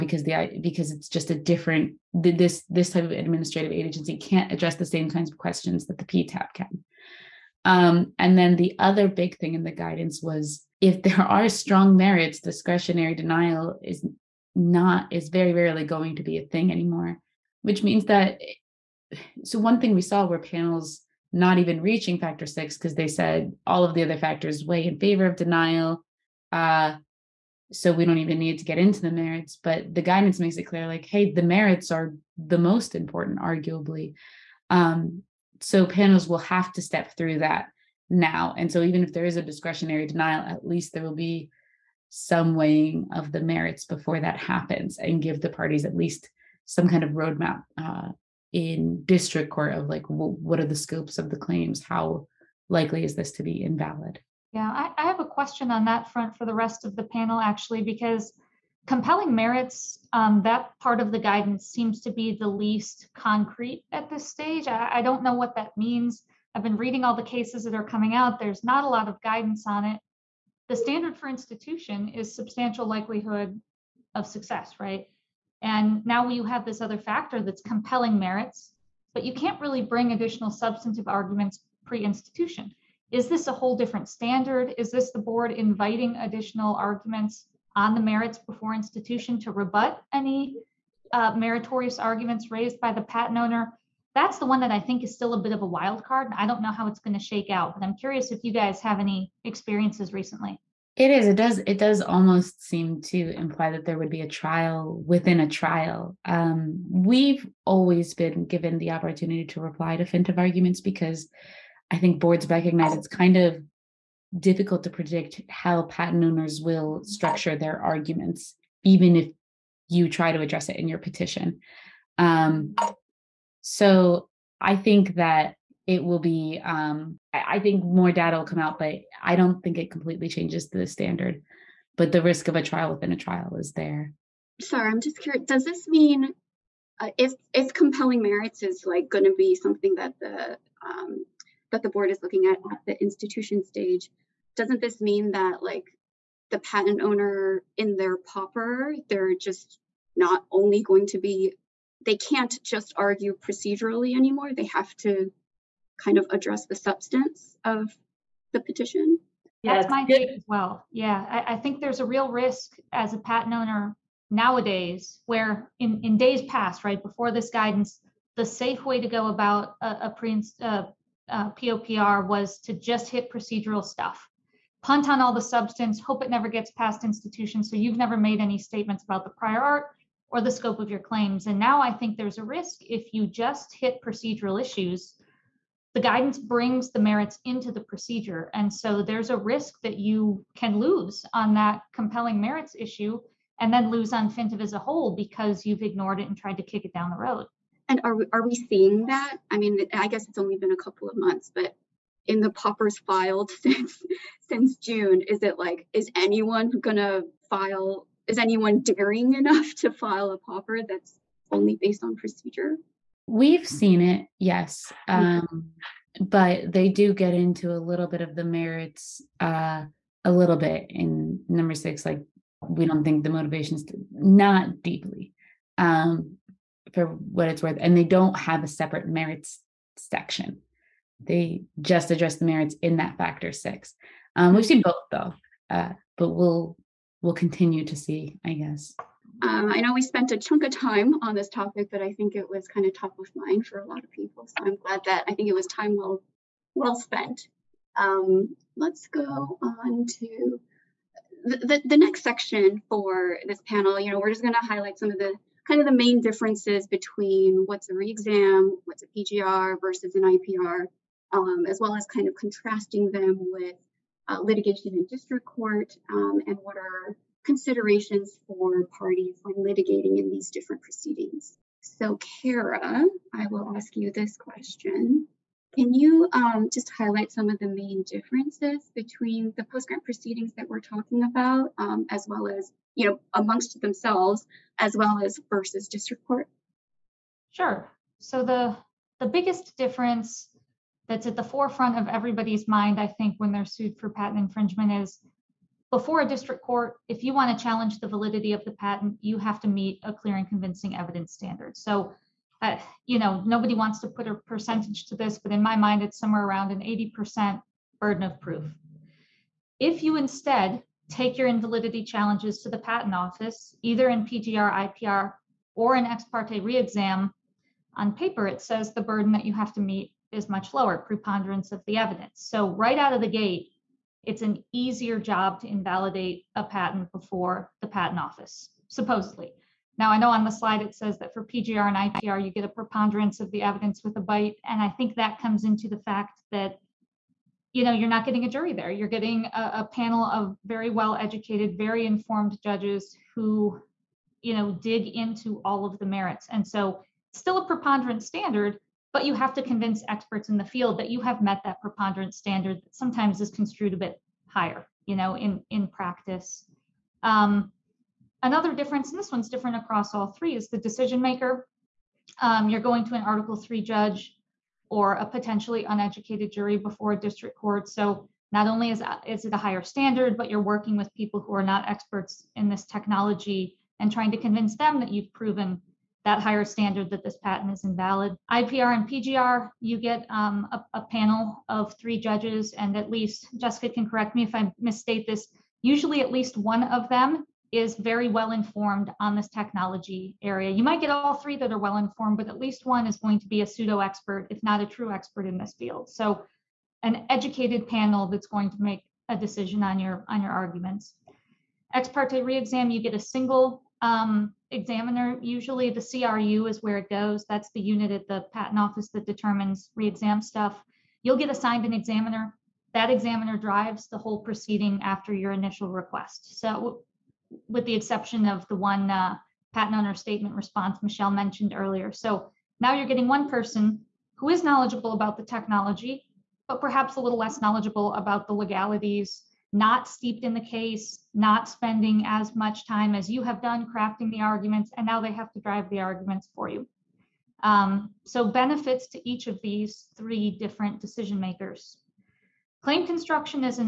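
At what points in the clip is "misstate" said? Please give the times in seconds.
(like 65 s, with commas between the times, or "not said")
384 s.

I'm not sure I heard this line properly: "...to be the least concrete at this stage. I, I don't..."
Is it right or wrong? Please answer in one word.
right.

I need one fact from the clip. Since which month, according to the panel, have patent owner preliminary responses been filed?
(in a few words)
June.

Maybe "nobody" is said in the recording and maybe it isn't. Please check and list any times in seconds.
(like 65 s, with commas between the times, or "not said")
303 s.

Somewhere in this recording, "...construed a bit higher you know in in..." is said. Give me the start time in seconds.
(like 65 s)
353 s.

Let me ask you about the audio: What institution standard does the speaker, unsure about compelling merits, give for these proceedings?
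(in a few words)
substantial likelihood of success.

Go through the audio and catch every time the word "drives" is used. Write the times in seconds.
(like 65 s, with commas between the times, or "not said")
413 s, 435 s.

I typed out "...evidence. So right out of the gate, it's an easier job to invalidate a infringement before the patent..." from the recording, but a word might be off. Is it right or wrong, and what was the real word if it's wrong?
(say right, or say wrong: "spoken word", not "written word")
wrong: "patent", not "infringement".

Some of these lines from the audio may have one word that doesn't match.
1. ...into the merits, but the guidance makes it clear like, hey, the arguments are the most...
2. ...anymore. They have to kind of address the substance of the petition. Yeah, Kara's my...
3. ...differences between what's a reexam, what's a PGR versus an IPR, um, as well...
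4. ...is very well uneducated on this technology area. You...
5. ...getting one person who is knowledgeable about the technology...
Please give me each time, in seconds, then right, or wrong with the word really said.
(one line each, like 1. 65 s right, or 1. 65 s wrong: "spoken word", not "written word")
1. 28 s wrong: "merits", not "arguments"
2. 154 s wrong: "That", not "Kara"
3. 256 s right
4. 387 s wrong: "informed", not "uneducated"
5. 423 s right.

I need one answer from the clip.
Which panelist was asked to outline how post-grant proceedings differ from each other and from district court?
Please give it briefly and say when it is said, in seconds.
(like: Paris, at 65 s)
Kara, at 272 s.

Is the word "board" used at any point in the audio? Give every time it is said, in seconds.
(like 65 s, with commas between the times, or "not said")
85 s, 112 s, 141 s.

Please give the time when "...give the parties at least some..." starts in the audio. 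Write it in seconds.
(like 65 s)
45 s.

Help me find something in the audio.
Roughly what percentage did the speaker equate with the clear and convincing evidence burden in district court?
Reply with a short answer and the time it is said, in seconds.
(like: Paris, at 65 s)
80%, at 306 s.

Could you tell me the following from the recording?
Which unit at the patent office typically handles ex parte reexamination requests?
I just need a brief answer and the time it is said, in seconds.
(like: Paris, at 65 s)
the CRU, at 406 s.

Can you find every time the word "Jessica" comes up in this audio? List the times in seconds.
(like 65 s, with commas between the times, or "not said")
383 s.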